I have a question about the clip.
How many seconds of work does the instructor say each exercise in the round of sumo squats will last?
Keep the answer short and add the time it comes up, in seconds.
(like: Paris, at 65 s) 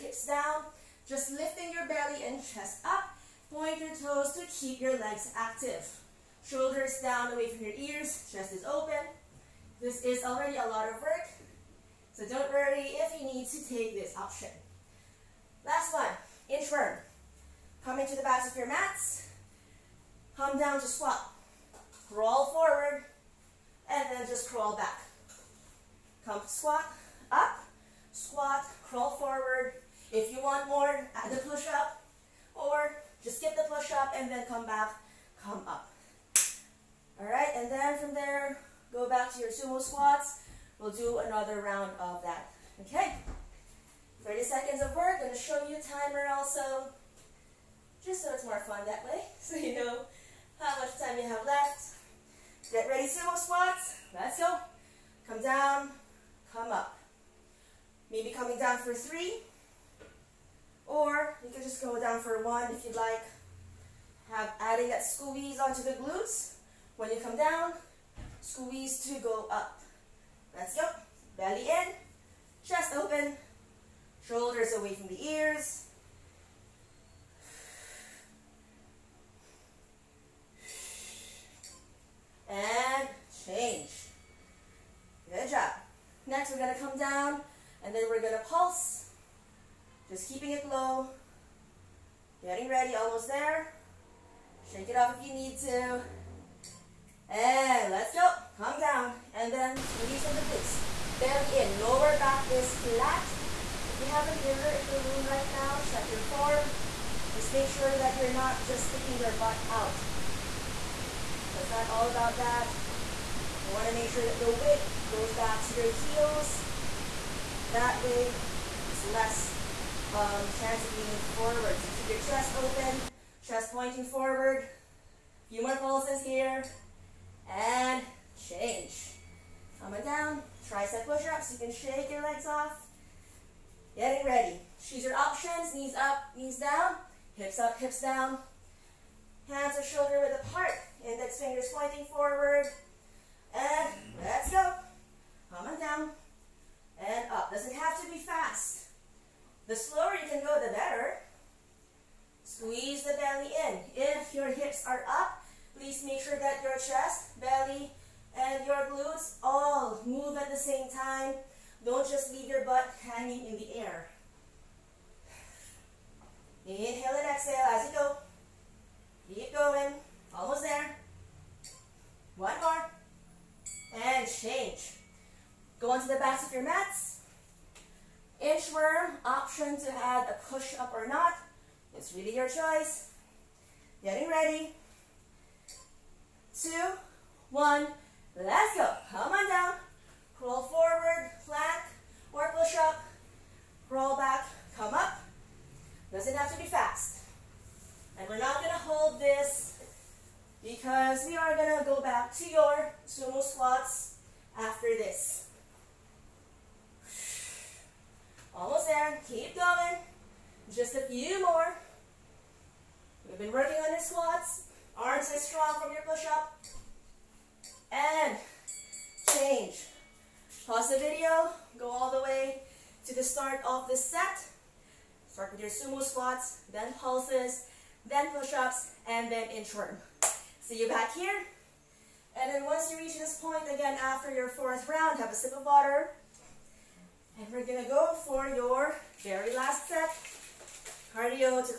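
30, at 44 s.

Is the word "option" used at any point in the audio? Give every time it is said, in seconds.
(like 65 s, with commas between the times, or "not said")
14 s, 135 s, 179 s.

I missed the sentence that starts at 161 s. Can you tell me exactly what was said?
Don't just leave your butt hanging in the air.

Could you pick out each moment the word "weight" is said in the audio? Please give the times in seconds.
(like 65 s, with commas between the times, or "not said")
114 s.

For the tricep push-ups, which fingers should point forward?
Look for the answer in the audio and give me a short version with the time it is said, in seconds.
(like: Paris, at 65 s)
Index fingers, at 141 s.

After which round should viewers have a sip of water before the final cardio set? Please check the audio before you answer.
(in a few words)
fourth round.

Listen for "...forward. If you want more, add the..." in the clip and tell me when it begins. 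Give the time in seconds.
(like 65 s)
29 s.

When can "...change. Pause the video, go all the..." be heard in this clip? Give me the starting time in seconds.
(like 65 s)
219 s.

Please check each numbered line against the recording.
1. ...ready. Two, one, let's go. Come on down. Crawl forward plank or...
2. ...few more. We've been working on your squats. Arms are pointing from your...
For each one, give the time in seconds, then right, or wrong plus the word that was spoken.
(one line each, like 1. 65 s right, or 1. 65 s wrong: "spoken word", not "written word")
1. 184 s right
2. 211 s wrong: "strong", not "pointing".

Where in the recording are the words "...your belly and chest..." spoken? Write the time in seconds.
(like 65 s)
1 s.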